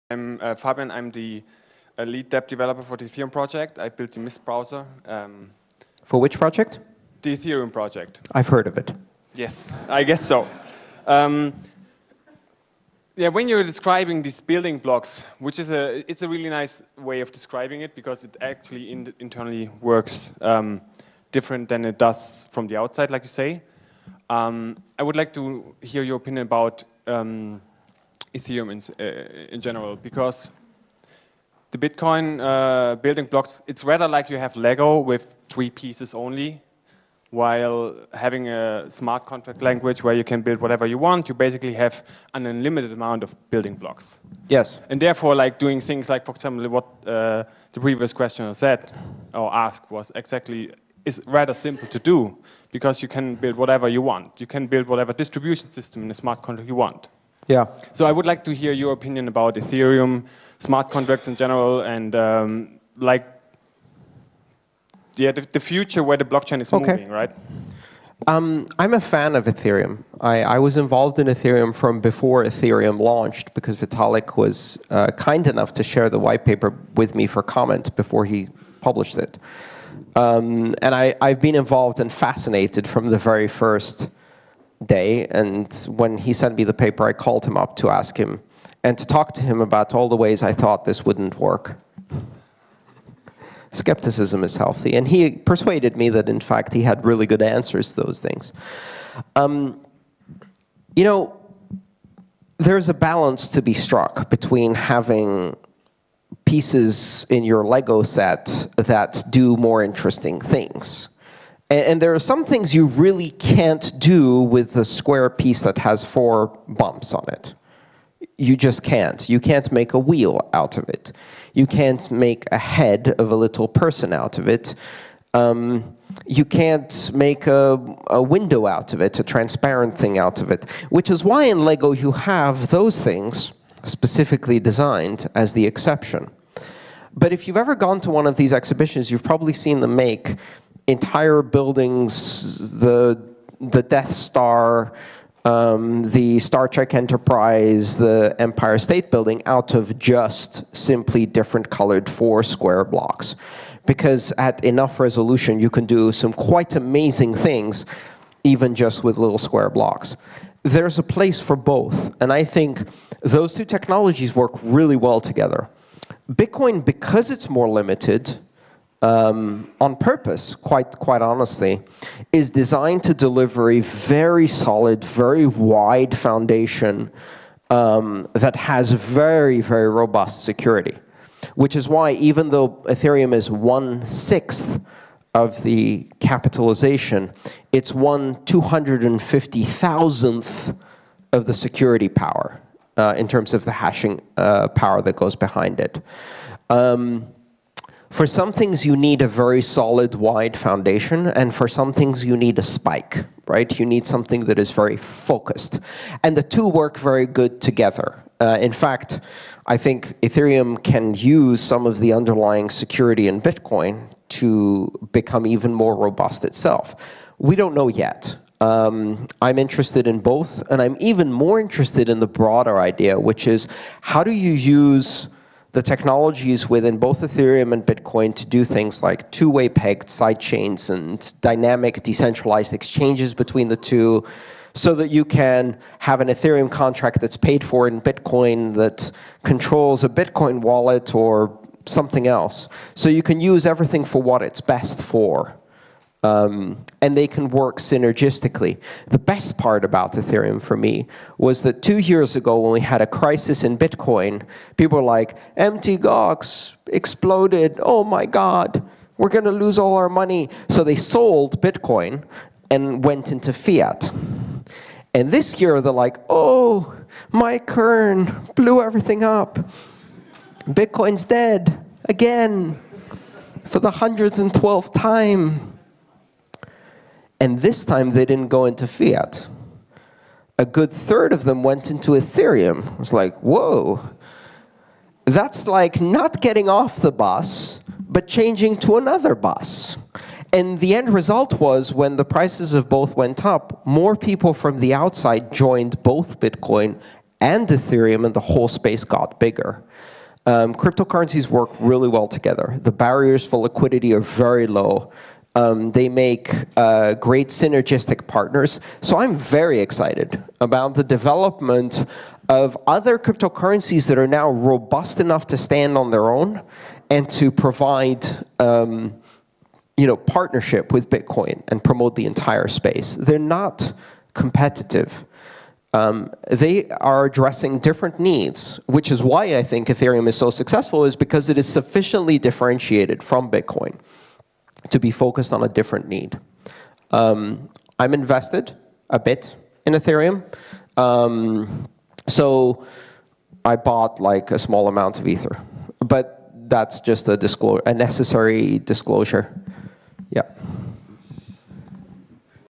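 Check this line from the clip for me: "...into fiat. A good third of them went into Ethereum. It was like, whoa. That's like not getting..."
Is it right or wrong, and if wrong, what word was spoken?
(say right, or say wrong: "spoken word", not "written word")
right.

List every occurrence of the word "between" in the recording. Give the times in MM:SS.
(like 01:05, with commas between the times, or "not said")
01:44, 03:53.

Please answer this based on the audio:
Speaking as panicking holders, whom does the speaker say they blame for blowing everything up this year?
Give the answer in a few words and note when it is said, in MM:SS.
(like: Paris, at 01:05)
Mike Hearn, at 04:27.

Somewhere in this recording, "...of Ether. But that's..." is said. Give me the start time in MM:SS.
05:45.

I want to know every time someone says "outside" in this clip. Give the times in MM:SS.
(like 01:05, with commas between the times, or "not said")
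00:22, 04:54.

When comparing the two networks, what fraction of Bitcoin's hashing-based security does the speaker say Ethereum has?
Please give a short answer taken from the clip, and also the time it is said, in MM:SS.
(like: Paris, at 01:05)
1/250,000, at 03:07.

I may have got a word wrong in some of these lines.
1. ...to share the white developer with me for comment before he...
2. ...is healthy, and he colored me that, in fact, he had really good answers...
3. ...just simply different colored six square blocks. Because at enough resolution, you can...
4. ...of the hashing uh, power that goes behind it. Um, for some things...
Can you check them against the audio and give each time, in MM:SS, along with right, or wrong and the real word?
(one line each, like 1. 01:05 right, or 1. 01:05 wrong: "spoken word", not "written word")
1. 01:15 wrong: "paper", not "developer"
2. 01:34 wrong: "persuaded", not "colored"
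3. 02:29 wrong: "four", not "six"
4. 03:13 right.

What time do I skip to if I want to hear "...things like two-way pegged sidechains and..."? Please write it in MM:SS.
03:48.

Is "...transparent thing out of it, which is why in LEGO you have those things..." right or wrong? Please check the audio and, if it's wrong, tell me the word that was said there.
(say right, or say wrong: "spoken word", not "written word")
right.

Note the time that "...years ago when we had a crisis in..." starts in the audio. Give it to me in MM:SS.
04:11.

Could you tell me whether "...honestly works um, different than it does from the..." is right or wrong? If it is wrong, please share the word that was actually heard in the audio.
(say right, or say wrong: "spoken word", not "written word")
wrong: "internally", not "honestly".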